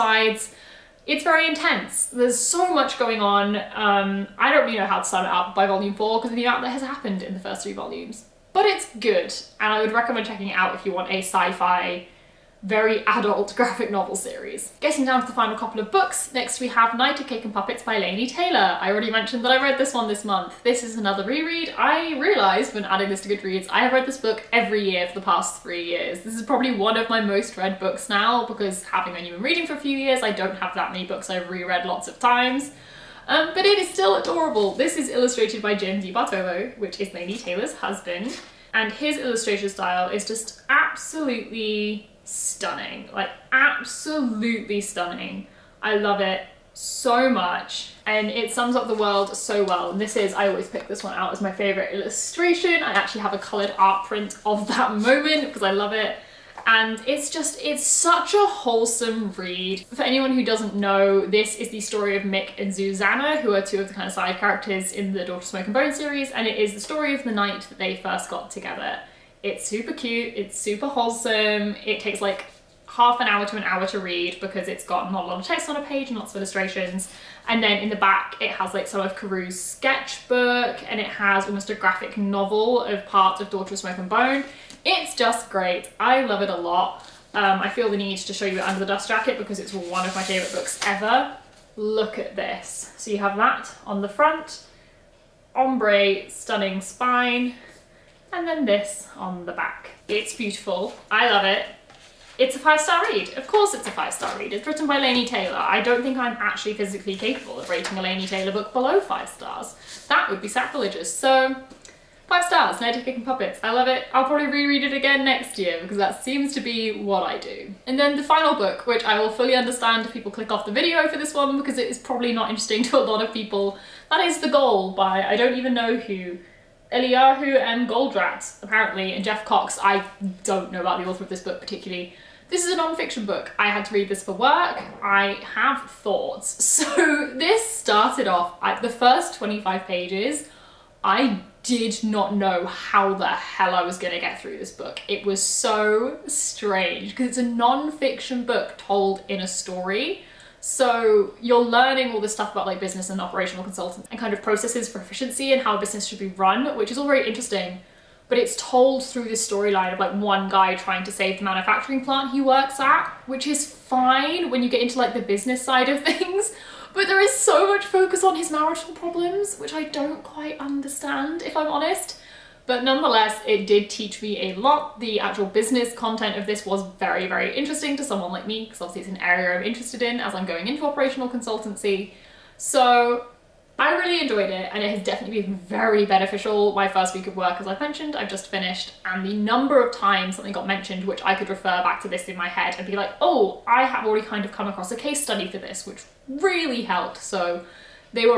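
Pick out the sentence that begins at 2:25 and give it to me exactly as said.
It was so strange because it's a non-fiction book told in a story.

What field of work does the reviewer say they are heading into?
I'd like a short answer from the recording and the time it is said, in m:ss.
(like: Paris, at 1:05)
operational consultancy, at 3:00.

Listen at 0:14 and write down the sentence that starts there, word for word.
Getting down to the final couple of books, next we have Night of Cake and Puppets by Laini Taylor.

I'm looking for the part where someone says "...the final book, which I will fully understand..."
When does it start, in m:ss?
1:58.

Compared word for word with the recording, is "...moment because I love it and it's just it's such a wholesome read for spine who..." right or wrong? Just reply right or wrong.
wrong.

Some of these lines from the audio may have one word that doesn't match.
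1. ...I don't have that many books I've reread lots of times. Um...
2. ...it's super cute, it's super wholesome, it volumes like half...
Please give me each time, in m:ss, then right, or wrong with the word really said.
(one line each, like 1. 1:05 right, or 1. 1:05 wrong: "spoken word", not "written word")
1. 0:30 right
2. 1:09 wrong: "takes", not "volumes".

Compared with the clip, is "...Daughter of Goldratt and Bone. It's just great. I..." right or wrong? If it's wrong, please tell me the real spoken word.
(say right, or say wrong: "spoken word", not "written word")
wrong: "Smoke", not "Goldratt".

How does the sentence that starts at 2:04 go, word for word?
That is The Goal by I don't even know who Eliyahu and Goldratt, apparently, and Jeff Cox.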